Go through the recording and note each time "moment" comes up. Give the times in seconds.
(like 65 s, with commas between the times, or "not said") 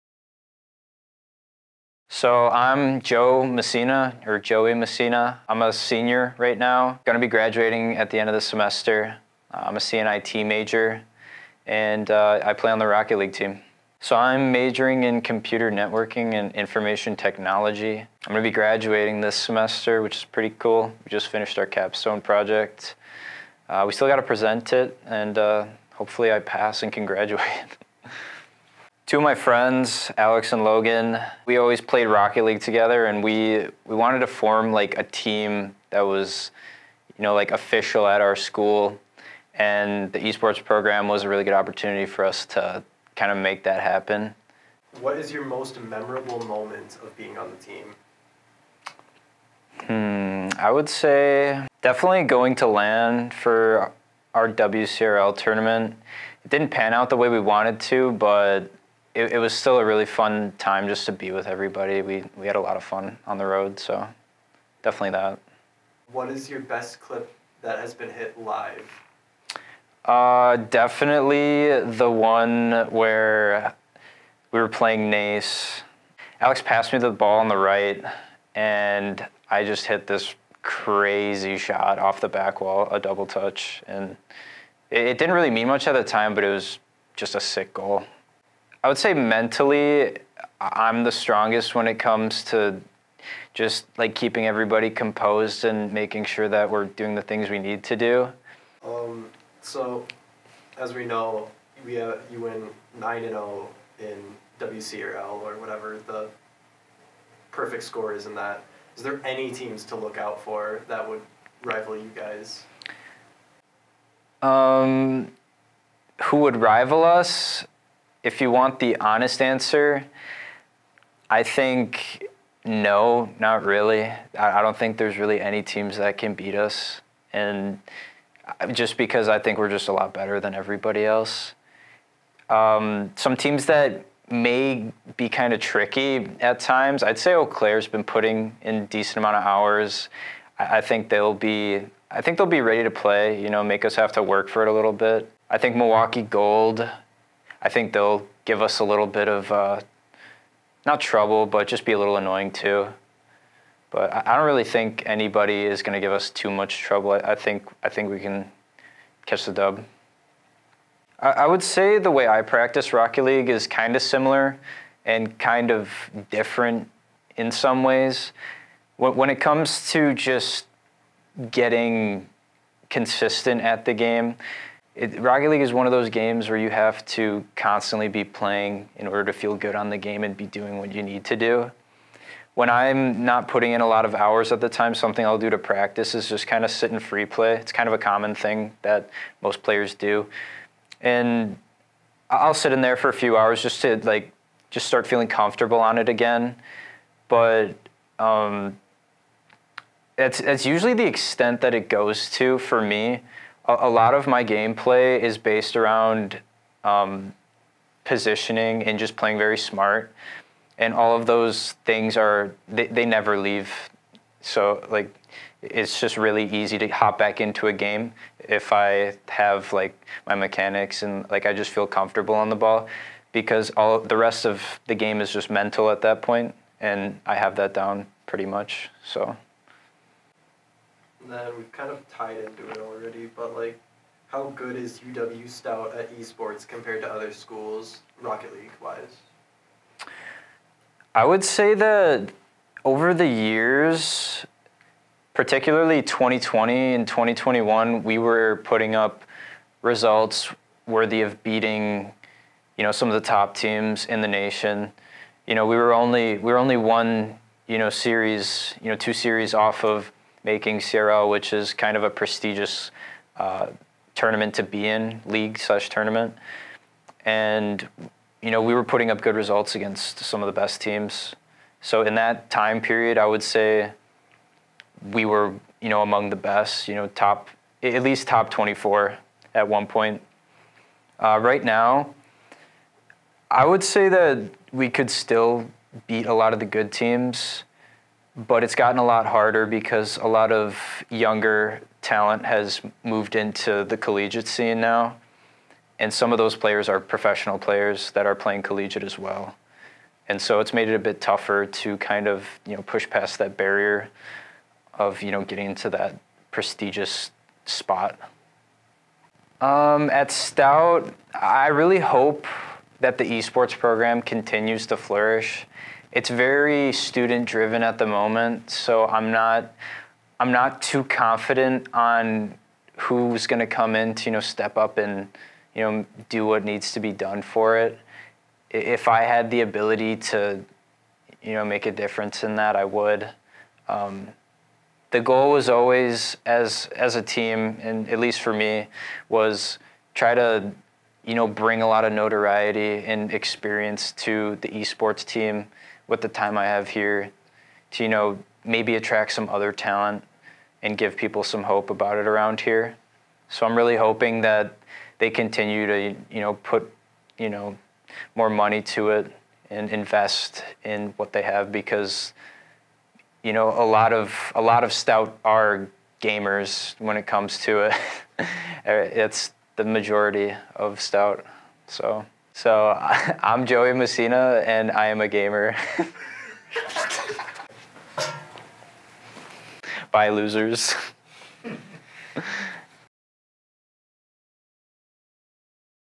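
46 s, 318 s.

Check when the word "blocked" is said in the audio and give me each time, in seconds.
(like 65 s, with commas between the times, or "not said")
not said.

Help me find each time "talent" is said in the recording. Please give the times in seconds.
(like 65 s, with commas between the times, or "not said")
292 s, 349 s.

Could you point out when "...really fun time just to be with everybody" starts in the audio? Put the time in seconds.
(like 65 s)
59 s.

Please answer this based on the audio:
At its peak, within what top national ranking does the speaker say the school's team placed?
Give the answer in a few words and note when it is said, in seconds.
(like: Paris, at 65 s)
top 24, at 278 s.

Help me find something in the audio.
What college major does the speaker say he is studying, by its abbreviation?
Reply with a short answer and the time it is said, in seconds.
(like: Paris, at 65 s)
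CNIT, at 9 s.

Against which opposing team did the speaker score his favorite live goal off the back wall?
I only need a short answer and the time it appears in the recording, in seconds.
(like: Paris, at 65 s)
Nace, at 75 s.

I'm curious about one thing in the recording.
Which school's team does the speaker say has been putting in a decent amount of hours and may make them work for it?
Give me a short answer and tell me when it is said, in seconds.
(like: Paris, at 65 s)
Eau Claire, at 137 s.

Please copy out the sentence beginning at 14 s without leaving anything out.
So I'm majoring in computer networking and information technology.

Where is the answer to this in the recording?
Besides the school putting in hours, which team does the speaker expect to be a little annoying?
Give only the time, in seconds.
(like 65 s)
145 s.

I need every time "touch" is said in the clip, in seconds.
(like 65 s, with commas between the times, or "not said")
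83 s.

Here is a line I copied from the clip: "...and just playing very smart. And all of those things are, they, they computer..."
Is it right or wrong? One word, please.
wrong.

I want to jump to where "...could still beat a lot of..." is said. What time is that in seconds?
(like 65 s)
284 s.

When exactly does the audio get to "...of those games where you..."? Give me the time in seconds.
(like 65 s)
175 s.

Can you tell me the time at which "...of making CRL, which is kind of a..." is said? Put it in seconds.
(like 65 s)
259 s.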